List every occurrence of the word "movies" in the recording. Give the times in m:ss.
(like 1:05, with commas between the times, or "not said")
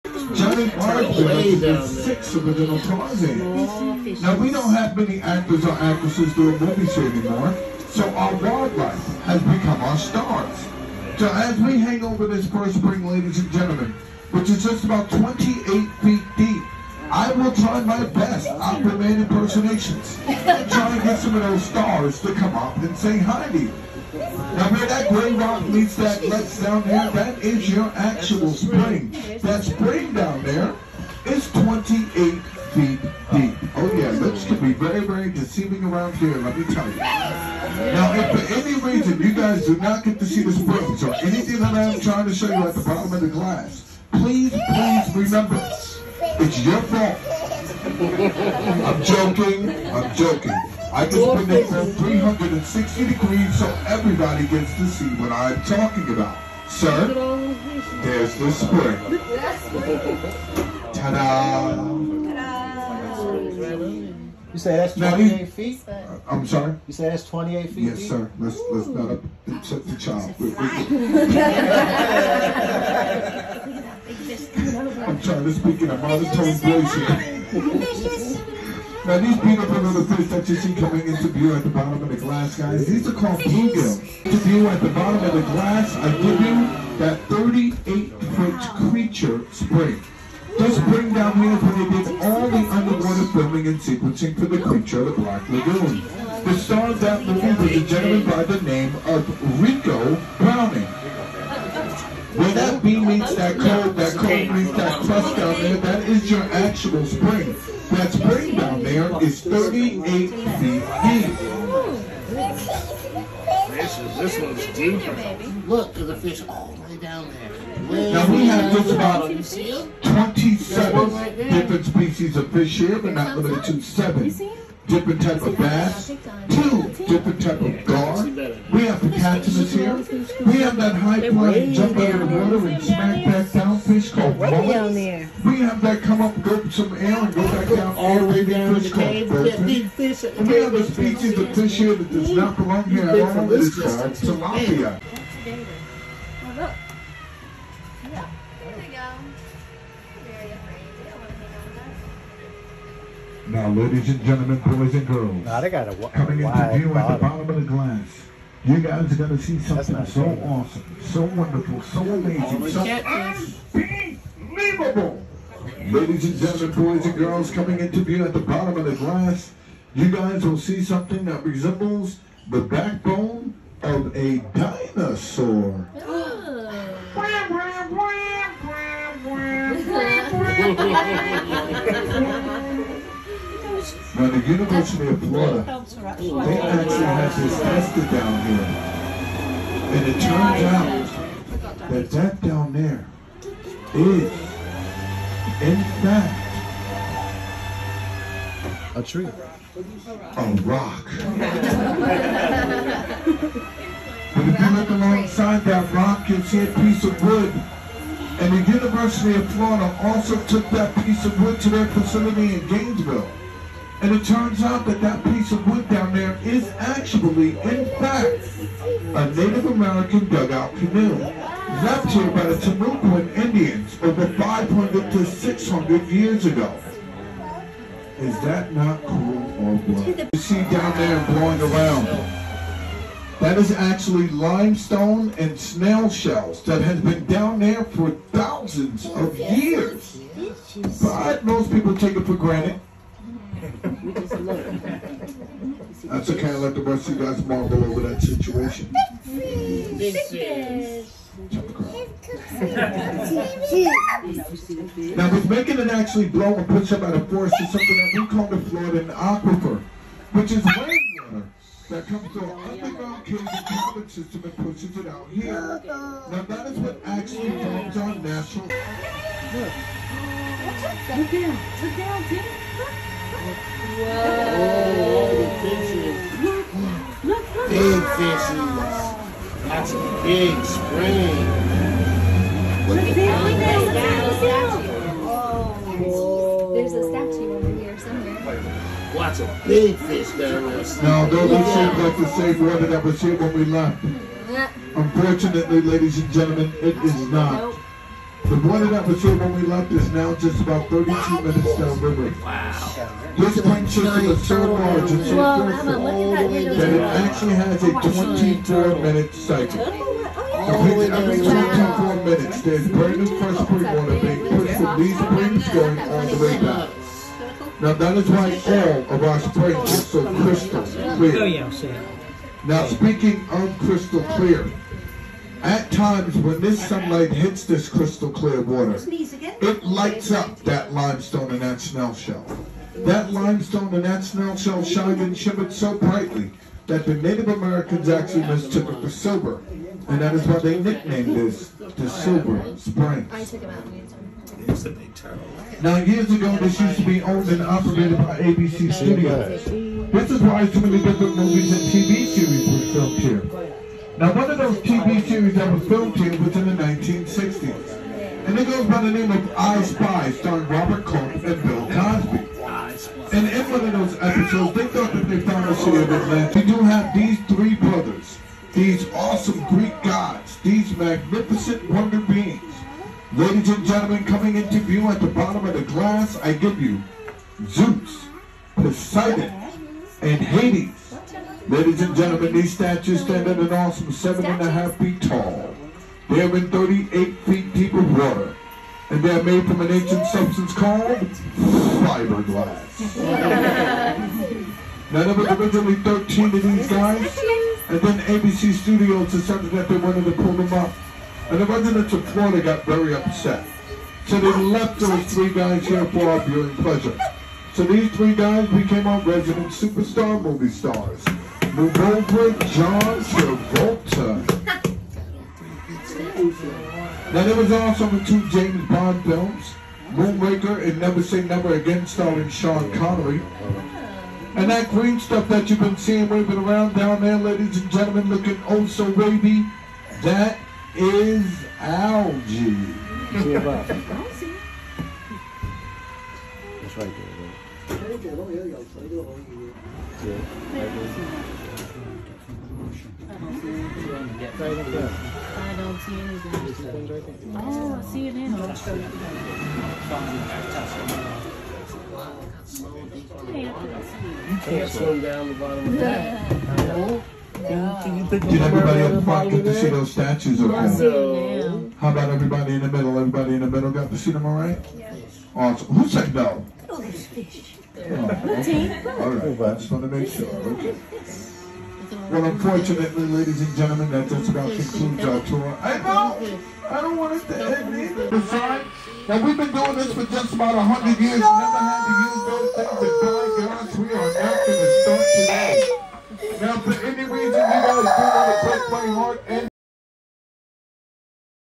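0:06, 1:37, 5:51, 6:50.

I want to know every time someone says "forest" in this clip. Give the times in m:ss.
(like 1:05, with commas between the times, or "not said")
4:17.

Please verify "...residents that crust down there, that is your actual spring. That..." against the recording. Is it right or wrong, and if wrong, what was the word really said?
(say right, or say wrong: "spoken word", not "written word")
wrong: "meets", not "residents".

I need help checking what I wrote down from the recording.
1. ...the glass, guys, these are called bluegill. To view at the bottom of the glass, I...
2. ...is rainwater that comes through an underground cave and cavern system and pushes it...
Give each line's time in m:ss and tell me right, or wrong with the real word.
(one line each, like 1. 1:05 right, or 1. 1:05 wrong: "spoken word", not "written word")
1. 1:22 right
2. 4:20 right.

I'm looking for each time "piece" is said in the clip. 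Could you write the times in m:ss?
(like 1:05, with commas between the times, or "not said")
3:26, 3:31, 3:35.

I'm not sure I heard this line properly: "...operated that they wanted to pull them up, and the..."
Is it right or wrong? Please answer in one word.
wrong.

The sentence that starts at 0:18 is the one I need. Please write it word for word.
I'll remain impersonations and try and get some of those stars to come up and say hi to you.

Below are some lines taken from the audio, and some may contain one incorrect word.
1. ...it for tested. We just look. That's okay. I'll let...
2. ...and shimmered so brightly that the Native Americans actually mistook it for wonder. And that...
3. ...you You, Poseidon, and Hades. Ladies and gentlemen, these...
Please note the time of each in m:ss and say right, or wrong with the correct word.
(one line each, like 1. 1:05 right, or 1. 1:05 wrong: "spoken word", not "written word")
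1. 4:02 wrong: "granted", not "tested"
2. 5:35 wrong: "silver", not "wonder"
3. 6:16 wrong: "Zeus", not "You".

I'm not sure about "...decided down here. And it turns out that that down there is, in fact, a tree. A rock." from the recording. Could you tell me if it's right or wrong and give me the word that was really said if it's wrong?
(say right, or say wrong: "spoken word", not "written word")
wrong: "tested", not "decided".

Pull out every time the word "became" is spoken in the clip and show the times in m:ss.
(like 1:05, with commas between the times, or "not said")
6:48.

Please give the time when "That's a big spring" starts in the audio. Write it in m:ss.
4:39.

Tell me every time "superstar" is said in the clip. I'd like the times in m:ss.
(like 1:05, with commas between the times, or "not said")
6:49.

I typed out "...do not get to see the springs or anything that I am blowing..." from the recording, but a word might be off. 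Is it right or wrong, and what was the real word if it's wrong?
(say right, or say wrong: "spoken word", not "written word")
wrong: "trying", not "blowing".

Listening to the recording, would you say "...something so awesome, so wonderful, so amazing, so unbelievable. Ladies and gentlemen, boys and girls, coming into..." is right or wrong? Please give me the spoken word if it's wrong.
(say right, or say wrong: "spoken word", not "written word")
right.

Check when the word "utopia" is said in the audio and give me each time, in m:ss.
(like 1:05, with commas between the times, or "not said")
not said.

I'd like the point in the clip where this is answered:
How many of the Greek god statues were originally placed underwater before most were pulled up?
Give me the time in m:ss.
6:35.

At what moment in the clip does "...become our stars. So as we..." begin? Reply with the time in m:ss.
0:09.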